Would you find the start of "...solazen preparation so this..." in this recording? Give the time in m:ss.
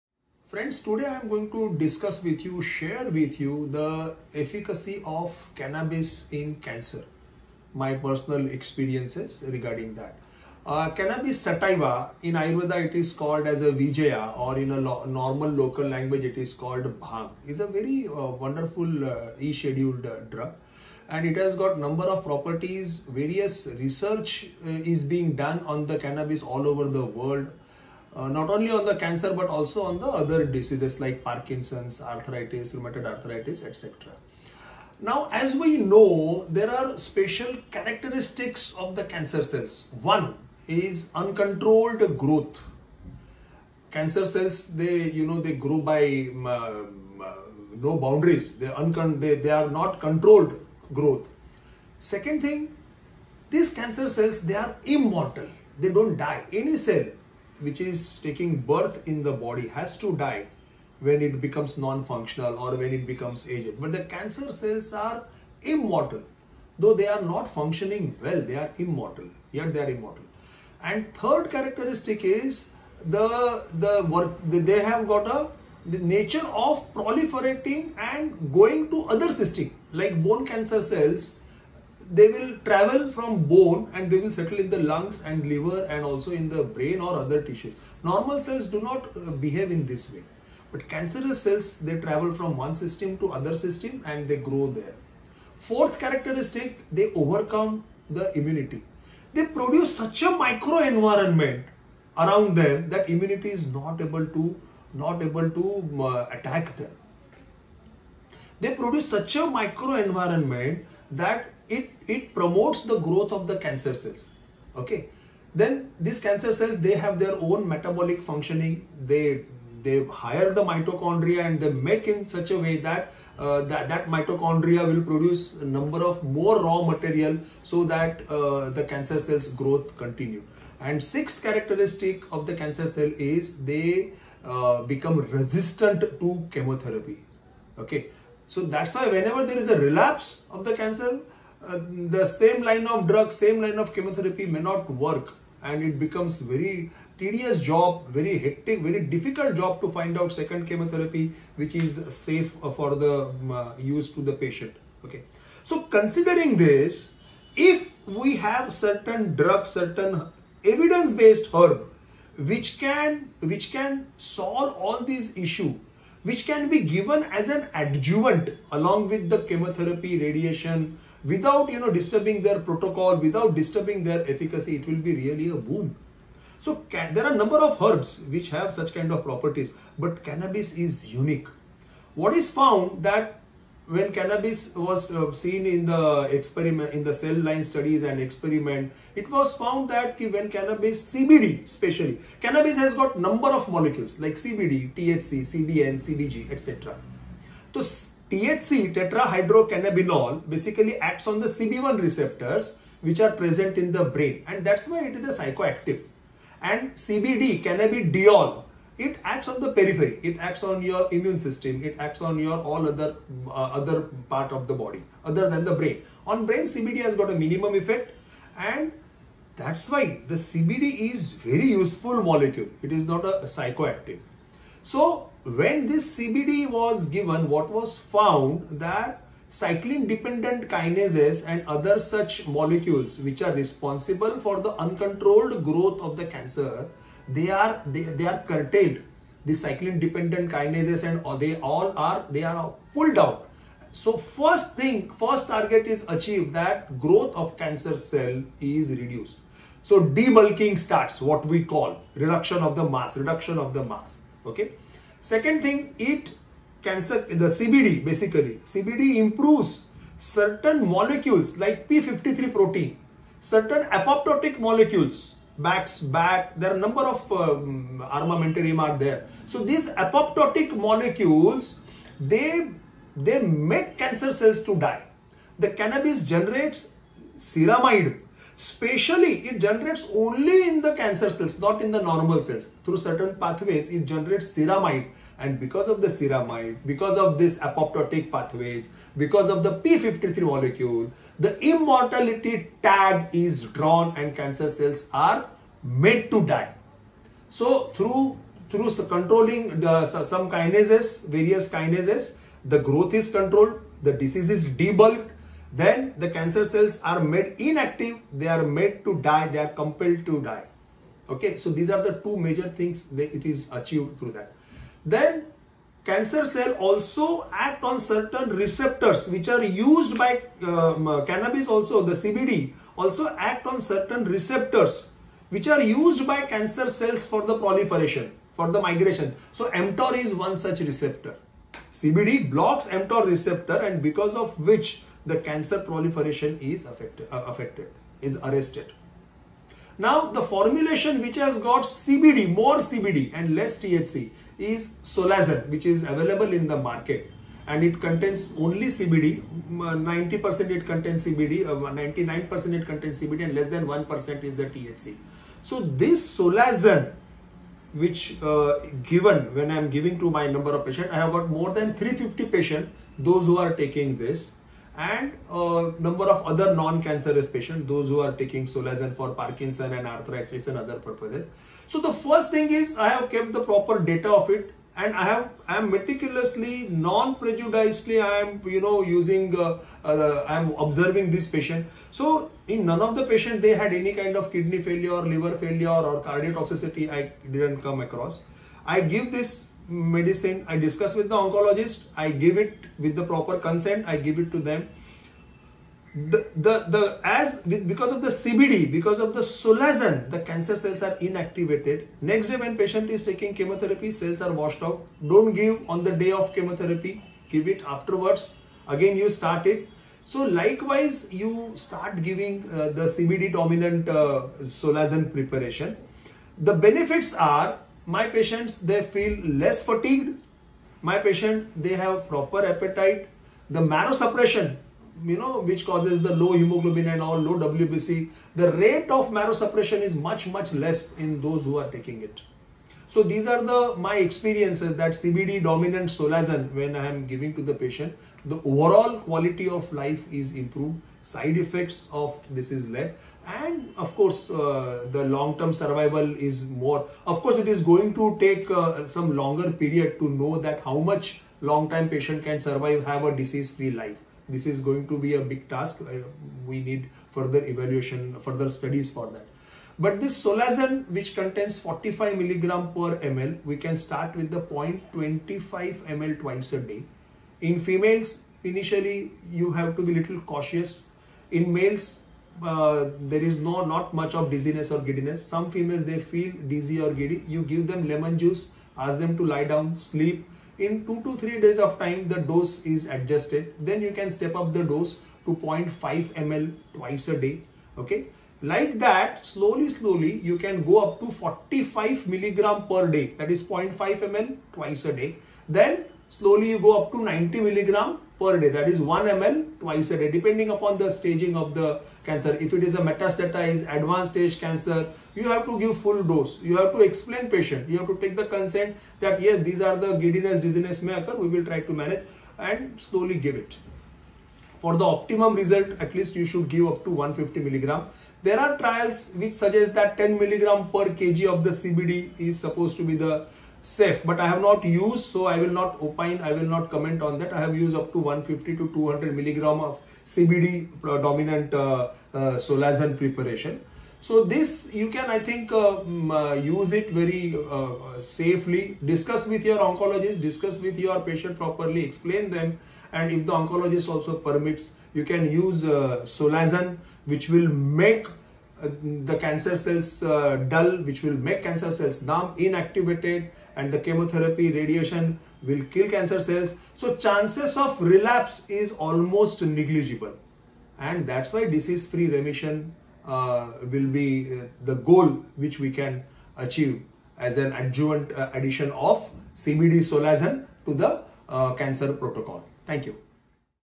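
8:52.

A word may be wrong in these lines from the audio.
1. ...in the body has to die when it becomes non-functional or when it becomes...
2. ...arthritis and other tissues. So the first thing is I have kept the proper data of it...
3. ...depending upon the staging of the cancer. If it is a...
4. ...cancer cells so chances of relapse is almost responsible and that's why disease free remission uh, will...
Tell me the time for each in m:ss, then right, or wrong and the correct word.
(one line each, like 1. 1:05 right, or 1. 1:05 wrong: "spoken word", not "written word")
1. 0:59 right
2. 6:10 wrong: "purposes", not "tissues"
3. 8:20 right
4. 9:16 wrong: "negligible", not "responsible".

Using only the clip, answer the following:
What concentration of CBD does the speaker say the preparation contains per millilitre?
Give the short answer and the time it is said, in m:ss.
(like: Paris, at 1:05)
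45 mg per ml, at 7:41.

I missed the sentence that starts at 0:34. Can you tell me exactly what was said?
Now, as we know, there are special characteristics of the cancer cells.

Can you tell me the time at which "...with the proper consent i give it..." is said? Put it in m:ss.
6:32.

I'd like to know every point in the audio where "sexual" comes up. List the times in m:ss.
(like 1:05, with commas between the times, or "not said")
not said.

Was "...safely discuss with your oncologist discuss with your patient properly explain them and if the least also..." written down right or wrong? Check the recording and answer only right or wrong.
wrong.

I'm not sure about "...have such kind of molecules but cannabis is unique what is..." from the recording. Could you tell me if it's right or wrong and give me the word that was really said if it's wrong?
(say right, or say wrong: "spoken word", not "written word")
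wrong: "properties", not "molecules".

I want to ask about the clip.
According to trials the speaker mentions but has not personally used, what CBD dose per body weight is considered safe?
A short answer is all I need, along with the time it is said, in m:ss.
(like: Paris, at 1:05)
10 mg per kg, at 8:40.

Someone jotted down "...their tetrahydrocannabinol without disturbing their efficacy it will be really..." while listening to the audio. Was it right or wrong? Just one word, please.
wrong.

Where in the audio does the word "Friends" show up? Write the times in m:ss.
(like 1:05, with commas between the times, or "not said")
0:00.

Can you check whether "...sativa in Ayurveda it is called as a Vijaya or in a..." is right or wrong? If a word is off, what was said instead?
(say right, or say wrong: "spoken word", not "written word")
right.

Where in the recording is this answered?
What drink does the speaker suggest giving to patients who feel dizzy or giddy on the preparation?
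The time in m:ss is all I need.
7:58.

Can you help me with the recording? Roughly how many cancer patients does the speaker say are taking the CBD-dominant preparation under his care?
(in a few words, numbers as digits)
More than 350.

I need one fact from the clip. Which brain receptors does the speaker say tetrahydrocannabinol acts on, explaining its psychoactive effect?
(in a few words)
CB1 receptors.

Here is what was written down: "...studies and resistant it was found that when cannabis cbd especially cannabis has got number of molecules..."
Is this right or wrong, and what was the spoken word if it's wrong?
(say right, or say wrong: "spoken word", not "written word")
wrong: "experiment", not "resistant".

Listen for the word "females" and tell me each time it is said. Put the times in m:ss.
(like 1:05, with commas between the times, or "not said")
7:47, 7:55.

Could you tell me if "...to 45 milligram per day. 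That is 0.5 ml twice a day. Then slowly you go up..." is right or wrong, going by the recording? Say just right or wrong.
right.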